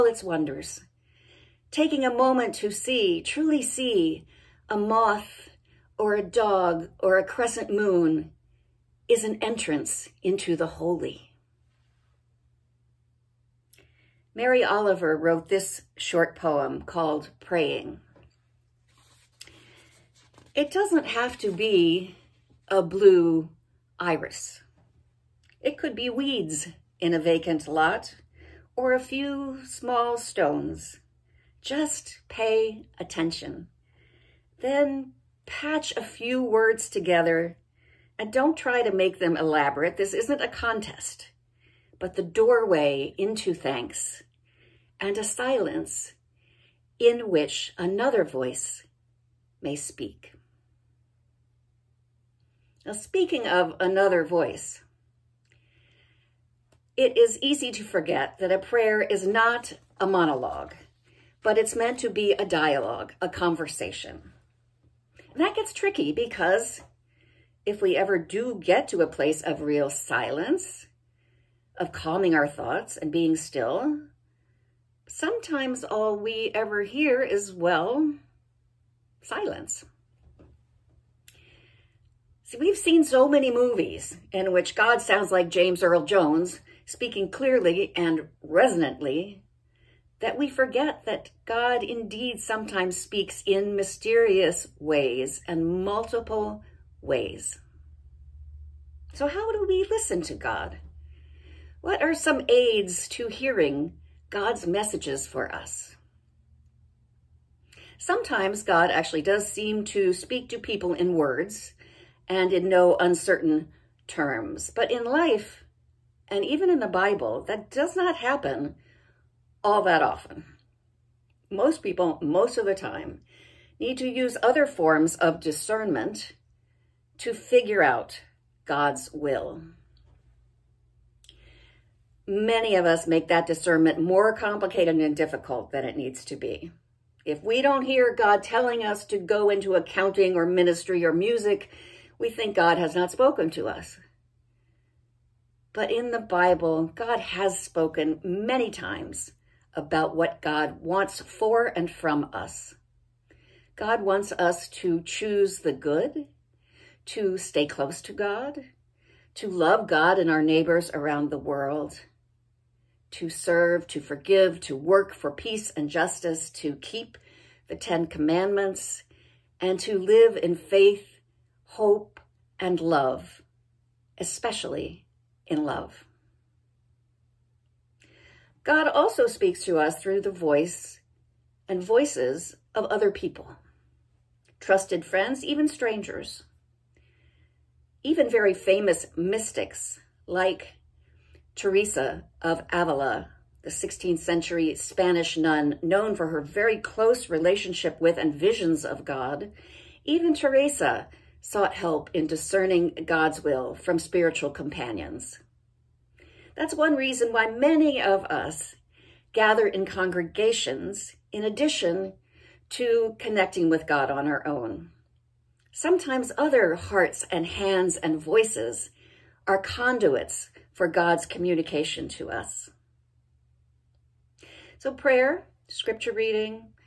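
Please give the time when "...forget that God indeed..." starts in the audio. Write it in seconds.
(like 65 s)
90 s.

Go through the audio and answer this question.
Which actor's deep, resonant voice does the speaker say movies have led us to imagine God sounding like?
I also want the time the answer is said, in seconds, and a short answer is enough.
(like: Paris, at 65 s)
James Earl Jones, at 85 s.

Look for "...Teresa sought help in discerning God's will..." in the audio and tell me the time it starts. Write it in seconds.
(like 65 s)
200 s.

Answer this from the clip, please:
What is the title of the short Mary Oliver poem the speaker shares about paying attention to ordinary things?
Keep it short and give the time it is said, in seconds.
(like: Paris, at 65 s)
Praying, at 17 s.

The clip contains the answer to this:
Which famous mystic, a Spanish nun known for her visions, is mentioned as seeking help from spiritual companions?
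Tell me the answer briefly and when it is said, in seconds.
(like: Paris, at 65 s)
Teresa of Avila, at 191 s.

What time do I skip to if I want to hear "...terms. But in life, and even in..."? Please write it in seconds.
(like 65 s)
114 s.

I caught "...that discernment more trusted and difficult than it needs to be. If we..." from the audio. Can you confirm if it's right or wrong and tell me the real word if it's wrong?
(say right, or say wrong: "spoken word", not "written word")
wrong: "complicated", not "trusted".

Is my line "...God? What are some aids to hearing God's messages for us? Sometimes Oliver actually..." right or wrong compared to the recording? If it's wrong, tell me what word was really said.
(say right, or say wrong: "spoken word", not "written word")
wrong: "God", not "Oliver".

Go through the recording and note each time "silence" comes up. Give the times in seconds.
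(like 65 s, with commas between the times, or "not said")
45 s, 69 s, 79 s.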